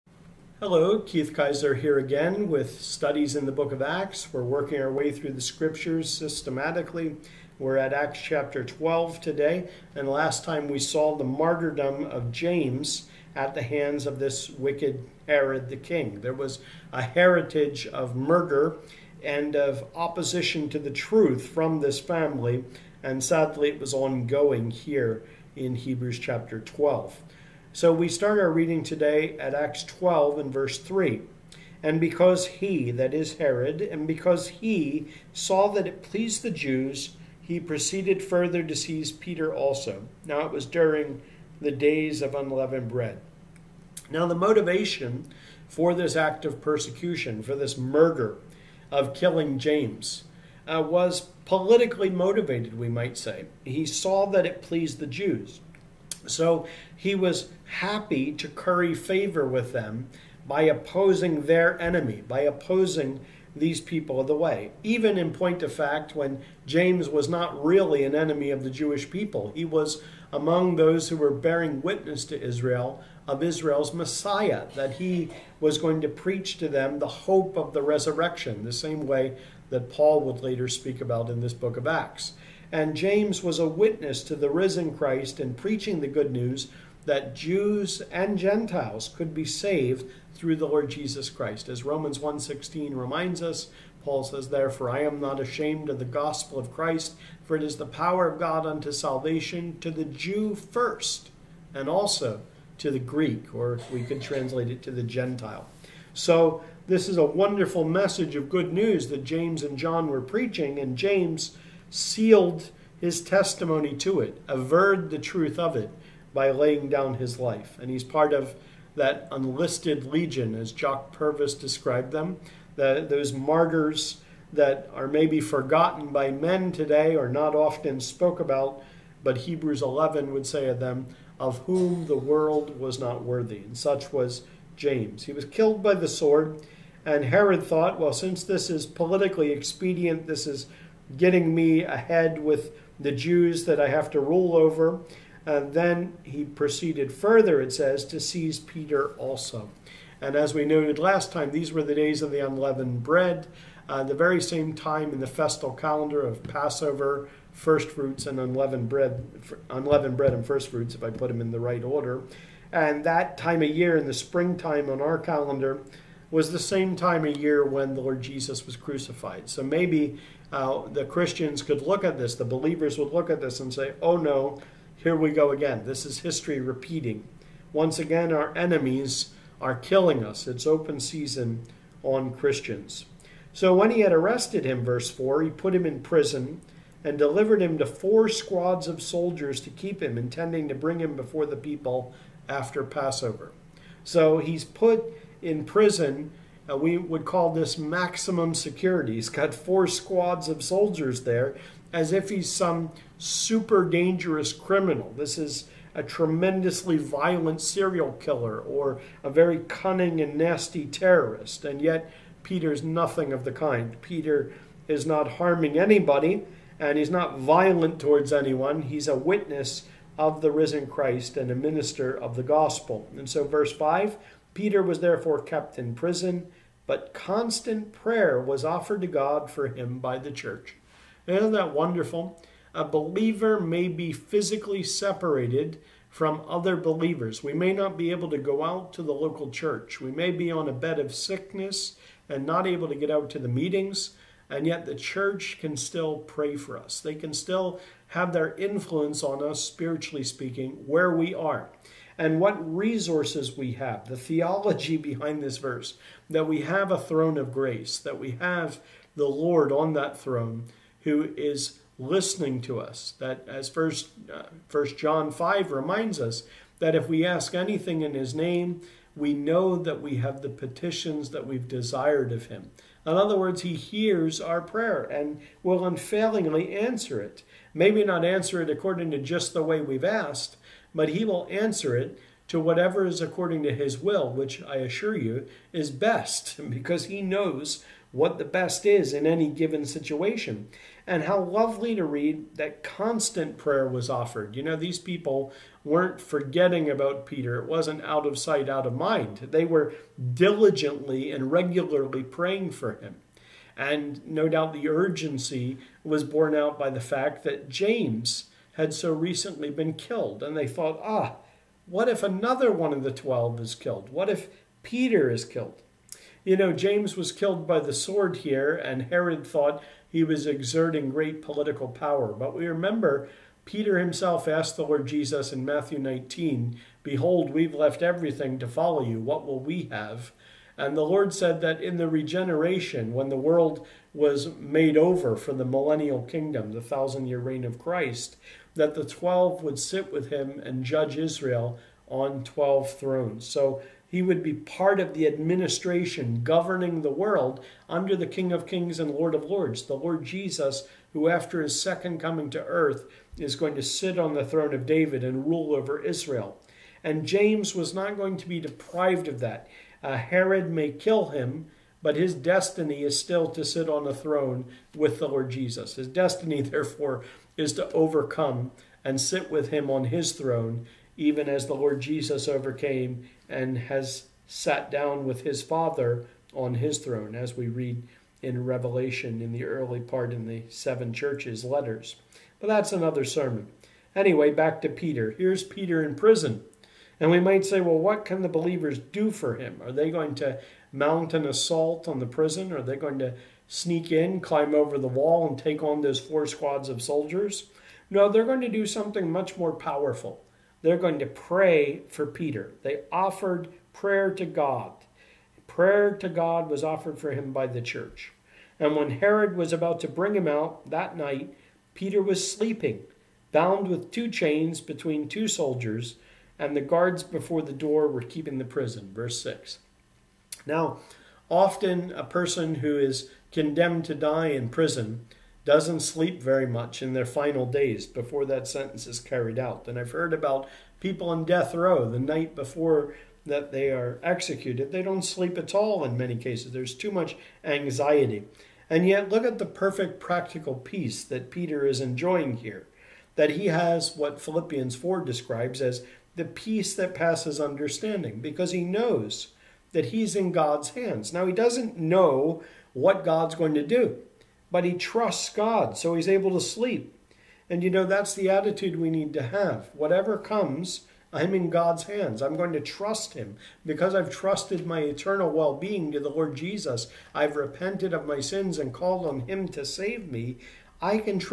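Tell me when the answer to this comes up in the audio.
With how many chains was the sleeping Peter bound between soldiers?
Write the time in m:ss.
6:54.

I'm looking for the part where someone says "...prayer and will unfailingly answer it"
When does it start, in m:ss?
4:34.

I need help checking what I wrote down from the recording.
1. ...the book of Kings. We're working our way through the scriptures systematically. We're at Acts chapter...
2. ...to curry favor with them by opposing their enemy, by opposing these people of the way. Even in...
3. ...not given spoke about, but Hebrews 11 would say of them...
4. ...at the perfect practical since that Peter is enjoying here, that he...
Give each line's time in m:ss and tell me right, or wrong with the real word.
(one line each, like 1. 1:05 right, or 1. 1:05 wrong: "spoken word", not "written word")
1. 0:03 wrong: "Acts", not "Kings"
2. 0:58 right
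3. 2:07 wrong: "often", not "given"
4. 7:19 wrong: "peace", not "since".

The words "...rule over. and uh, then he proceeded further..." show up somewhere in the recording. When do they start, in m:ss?
2:24.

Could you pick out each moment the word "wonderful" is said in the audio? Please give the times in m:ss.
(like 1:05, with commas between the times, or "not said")
1:47, 3:51.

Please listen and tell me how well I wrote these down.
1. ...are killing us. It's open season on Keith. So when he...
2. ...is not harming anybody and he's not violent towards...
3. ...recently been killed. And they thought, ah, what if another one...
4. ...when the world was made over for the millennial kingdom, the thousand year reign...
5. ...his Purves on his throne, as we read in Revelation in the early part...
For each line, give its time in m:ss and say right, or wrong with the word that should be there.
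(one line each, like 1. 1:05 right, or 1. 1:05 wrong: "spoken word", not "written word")
1. 2:59 wrong: "Christians", not "Keith"
2. 3:34 right
3. 5:09 right
4. 5:33 right
5. 6:15 wrong: "Father", not "Purves".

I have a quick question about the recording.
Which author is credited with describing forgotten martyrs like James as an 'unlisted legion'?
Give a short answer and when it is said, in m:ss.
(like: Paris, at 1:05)
Jock Purves, at 2:00.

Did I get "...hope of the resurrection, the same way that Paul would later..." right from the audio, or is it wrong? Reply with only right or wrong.
right.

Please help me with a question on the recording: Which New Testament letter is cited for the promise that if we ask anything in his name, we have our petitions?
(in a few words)
First John 5.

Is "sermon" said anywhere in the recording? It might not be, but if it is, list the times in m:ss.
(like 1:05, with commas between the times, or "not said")
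6:23.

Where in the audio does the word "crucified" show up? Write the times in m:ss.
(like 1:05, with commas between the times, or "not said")
2:48.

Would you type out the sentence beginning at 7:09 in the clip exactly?
And I've heard about people on death row the night before that they are executed.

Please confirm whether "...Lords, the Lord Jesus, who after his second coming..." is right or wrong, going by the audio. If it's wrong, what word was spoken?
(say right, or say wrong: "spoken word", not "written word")
right.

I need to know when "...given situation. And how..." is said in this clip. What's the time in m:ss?
4:49.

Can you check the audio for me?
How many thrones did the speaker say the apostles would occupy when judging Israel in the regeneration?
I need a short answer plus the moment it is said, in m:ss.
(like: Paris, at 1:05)
12, at 5:42.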